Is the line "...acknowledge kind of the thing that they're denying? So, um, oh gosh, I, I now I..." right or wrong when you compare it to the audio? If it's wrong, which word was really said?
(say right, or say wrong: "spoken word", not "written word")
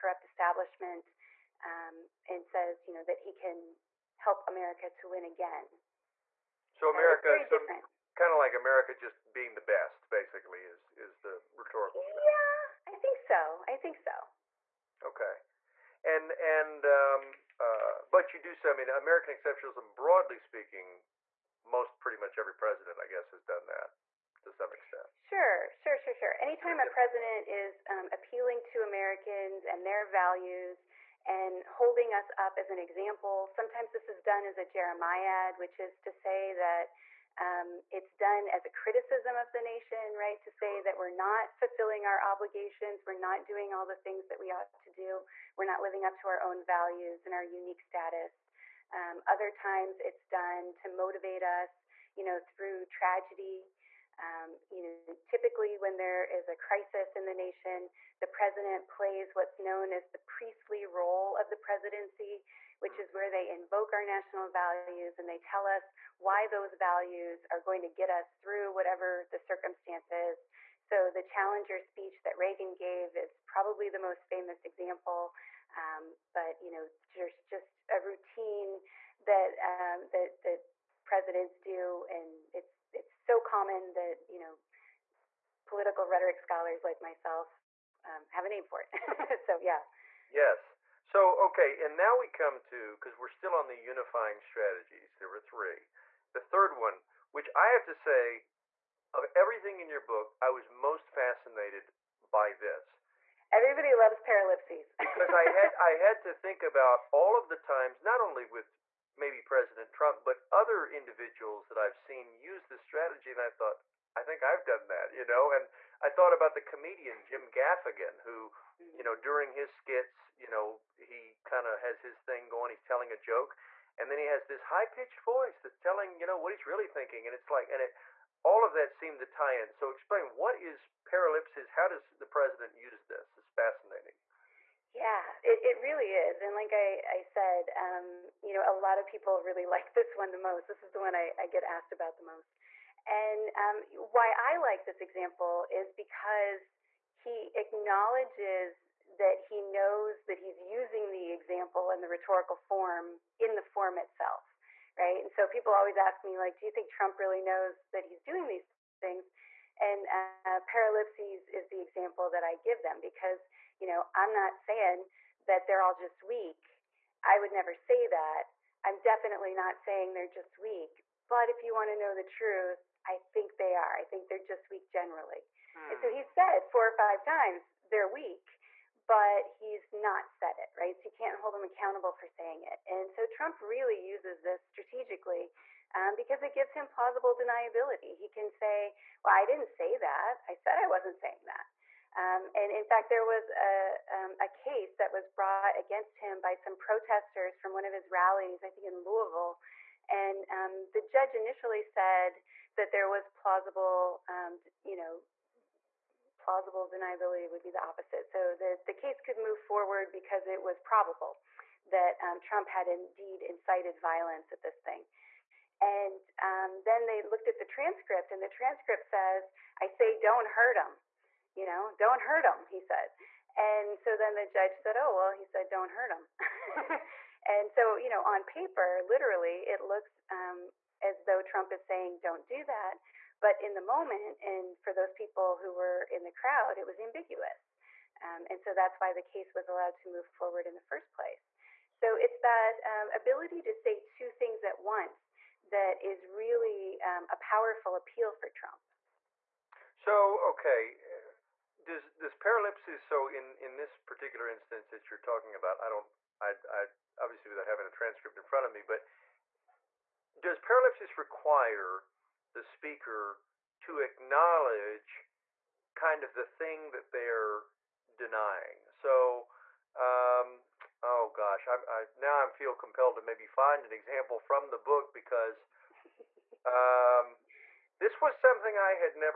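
right.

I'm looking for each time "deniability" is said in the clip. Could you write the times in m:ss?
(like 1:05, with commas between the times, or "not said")
3:07, 3:26.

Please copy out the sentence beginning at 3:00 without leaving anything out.
So you can't hold him accountable for saying it.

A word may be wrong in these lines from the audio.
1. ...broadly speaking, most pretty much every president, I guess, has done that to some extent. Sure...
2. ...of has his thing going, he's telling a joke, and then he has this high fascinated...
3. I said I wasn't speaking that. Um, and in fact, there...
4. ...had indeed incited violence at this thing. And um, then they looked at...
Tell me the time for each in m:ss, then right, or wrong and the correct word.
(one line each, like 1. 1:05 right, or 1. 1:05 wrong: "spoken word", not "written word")
1. 0:19 right
2. 2:01 wrong: "pitched", not "fascinated"
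3. 3:10 wrong: "saying", not "speaking"
4. 3:32 right.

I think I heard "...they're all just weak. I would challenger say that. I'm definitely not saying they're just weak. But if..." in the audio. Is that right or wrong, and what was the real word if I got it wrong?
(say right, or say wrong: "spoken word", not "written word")
wrong: "never", not "challenger".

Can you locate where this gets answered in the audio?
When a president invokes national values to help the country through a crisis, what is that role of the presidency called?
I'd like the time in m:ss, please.
1:00.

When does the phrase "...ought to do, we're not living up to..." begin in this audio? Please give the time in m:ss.
0:44.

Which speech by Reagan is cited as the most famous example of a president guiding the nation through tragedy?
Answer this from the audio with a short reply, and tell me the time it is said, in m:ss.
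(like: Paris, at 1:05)
The Challenger speech, at 1:11.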